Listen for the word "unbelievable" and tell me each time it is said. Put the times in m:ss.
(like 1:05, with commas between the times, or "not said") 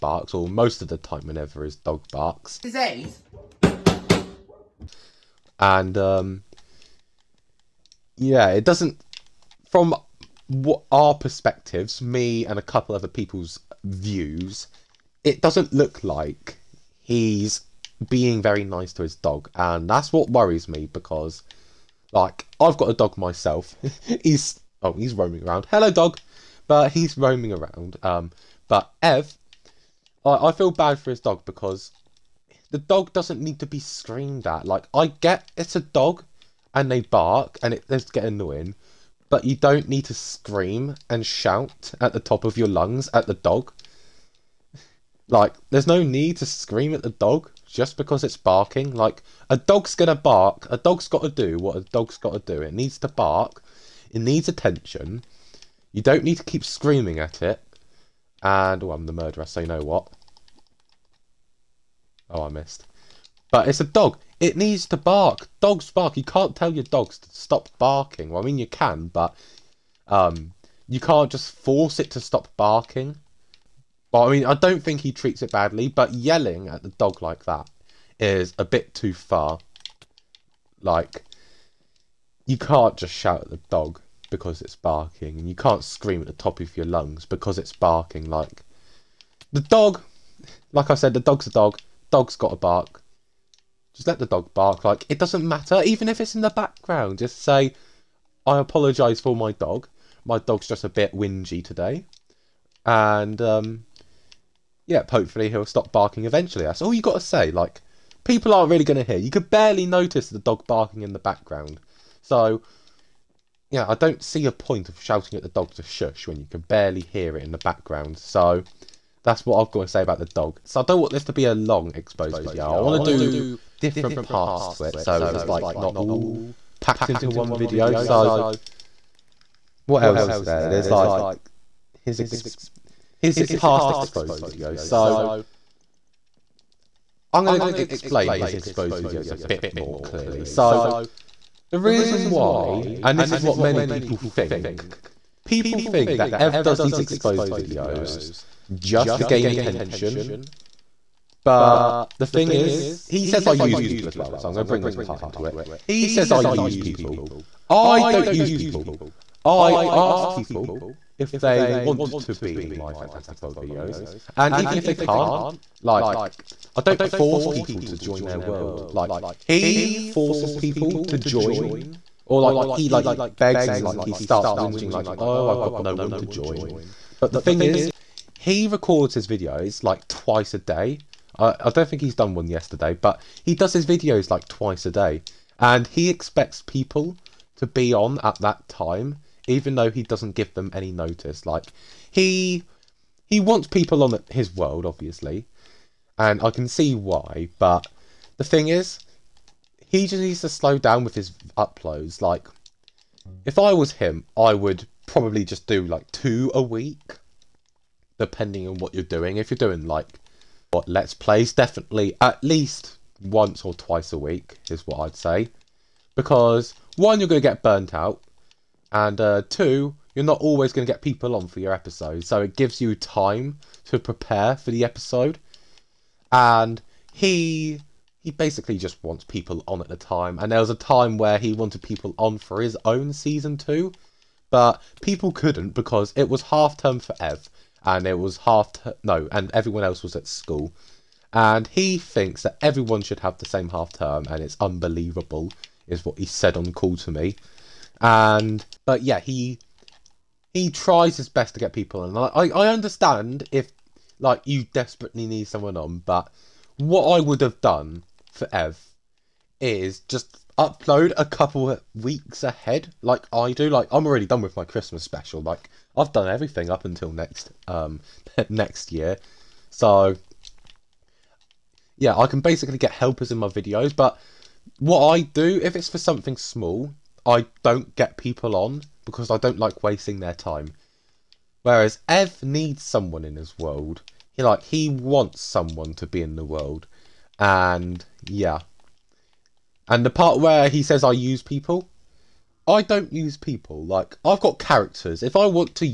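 4:04.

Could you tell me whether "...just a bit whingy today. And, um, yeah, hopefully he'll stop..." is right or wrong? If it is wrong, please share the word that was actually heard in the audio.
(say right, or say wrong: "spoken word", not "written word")
right.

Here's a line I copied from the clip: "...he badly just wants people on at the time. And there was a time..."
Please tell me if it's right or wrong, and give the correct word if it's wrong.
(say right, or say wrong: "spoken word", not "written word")
wrong: "basically", not "badly".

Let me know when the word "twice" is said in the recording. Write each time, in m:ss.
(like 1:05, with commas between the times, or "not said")
3:00, 3:04, 3:33.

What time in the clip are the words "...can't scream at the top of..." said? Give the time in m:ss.
1:25.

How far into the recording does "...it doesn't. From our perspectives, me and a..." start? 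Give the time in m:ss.
0:08.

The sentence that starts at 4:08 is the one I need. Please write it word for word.
And but yeah, he he tries his best to get people in.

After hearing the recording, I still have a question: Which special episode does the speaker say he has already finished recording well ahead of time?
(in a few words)
Christmas special.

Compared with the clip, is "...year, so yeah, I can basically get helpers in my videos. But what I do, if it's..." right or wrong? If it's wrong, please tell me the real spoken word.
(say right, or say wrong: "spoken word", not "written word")
right.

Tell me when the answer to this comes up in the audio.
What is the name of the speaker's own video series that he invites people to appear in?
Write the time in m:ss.
2:42.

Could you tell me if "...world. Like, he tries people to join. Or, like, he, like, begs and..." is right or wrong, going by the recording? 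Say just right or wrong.
wrong.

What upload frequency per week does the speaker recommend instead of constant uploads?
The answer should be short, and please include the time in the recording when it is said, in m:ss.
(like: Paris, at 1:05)
2 a week, at 3:26.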